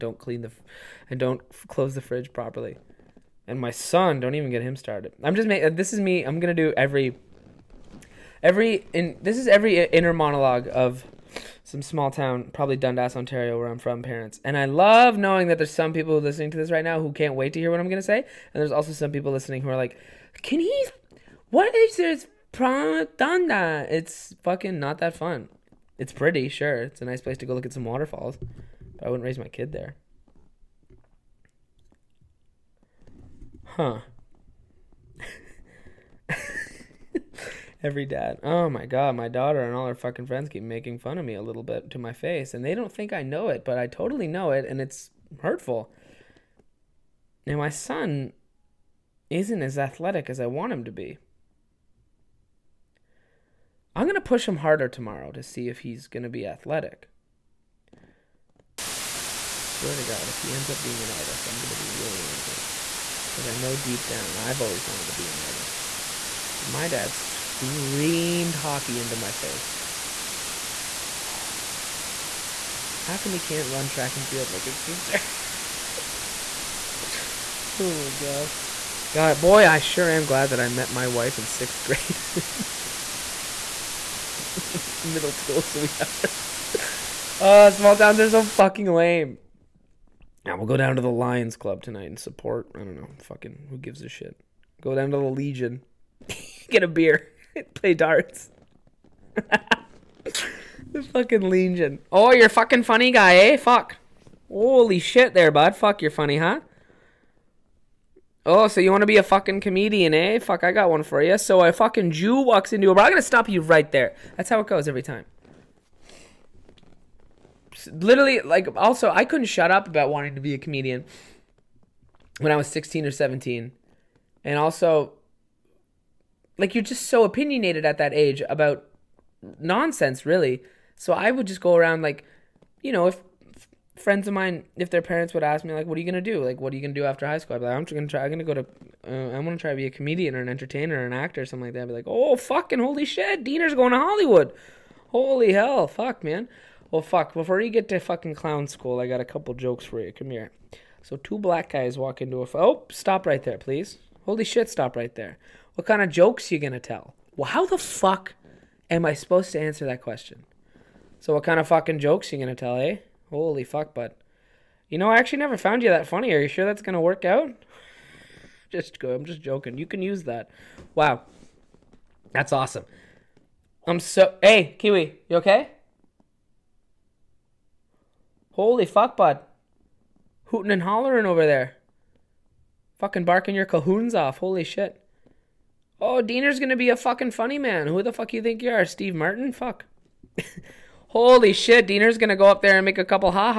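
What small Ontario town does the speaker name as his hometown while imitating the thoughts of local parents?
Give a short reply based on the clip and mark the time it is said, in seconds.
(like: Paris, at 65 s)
Dundas, at 12 s.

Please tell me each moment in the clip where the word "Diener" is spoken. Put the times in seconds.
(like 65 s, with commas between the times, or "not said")
143 s, 186 s, 191 s.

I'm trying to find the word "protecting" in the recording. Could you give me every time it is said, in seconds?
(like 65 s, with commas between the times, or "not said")
not said.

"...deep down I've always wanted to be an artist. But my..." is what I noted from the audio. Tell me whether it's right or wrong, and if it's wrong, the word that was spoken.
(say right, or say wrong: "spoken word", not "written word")
right.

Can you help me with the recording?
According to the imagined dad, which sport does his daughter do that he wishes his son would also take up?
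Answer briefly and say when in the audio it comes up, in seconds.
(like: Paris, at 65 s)
Track and field, at 73 s.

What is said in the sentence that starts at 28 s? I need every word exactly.
But I wouldn't raise my kid there.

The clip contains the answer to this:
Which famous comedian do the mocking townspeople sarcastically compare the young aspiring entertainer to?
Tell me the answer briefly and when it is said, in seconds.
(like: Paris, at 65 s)
Steve Martin, at 188 s.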